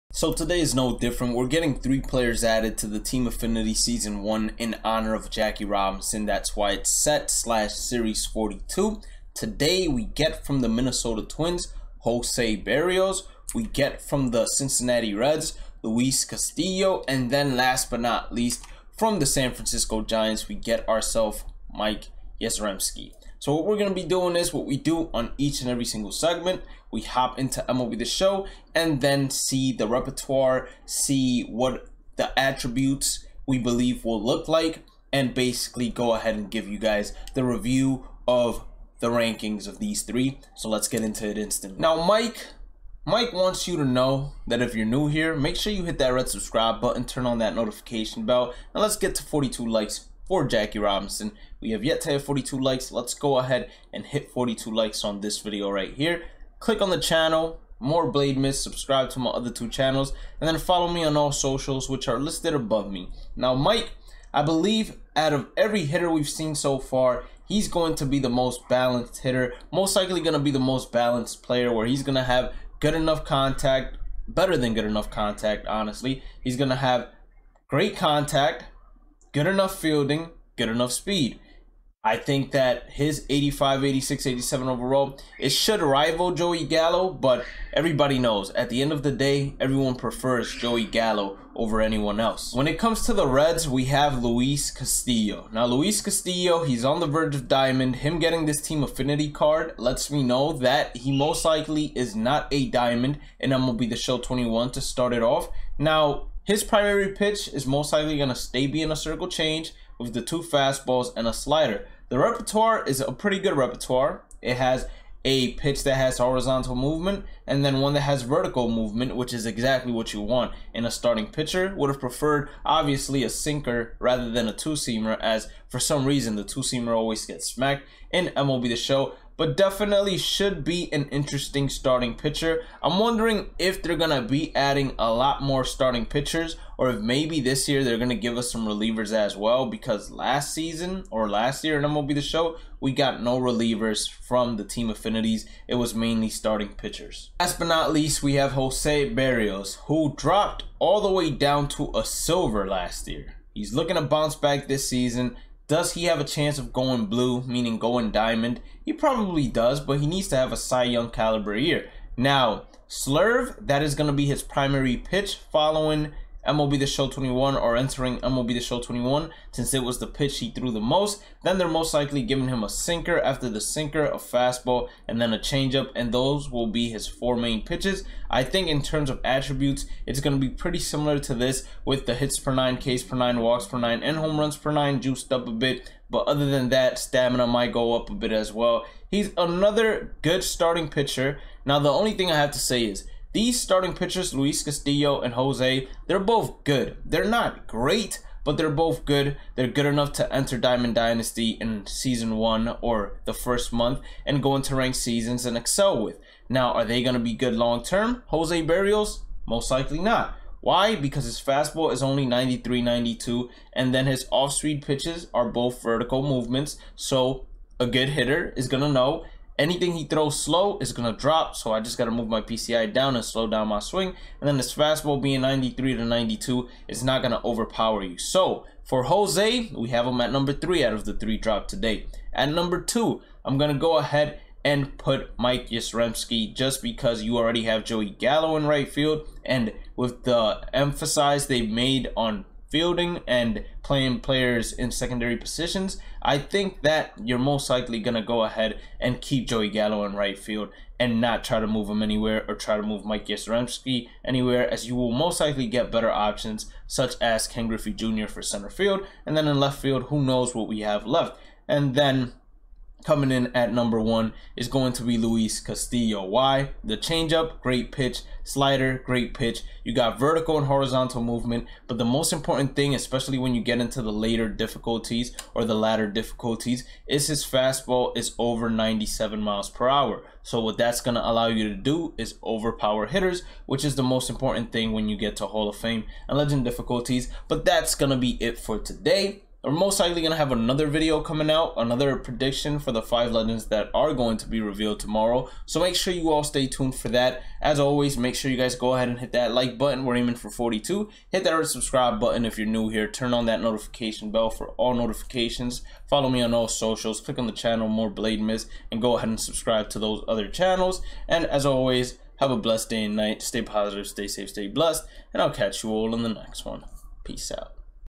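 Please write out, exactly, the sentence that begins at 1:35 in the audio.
Now, Luis Castillo, he's on the verge of diamond.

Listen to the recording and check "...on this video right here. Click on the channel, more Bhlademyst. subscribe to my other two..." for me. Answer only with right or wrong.
right.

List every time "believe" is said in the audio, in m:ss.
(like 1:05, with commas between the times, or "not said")
0:33, 1:04.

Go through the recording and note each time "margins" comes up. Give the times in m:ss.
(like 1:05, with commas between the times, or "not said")
not said.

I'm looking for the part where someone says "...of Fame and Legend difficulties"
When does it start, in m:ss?
4:45.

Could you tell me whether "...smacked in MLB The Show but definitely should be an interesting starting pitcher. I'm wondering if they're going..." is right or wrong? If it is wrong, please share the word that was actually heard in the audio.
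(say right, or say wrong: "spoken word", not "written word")
right.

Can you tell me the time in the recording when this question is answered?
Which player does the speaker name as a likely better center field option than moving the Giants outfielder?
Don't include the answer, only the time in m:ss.
4:17.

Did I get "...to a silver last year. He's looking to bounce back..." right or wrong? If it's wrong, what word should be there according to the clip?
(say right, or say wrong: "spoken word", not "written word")
right.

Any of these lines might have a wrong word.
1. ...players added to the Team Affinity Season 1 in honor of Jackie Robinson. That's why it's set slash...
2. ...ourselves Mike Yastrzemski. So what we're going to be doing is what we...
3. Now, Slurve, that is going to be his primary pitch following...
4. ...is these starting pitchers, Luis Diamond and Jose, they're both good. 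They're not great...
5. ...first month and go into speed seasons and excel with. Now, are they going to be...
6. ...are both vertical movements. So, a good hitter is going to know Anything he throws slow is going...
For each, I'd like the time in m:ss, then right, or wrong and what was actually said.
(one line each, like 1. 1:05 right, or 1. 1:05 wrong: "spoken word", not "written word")
1. 0:01 right
2. 0:20 right
3. 2:42 right
4. 3:12 wrong: "Castillo", not "Diamond"
5. 3:23 wrong: "ranked", not "speed"
6. 3:35 right.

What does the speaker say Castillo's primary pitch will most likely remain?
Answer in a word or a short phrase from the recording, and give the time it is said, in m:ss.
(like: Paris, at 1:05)
circle change, at 1:48.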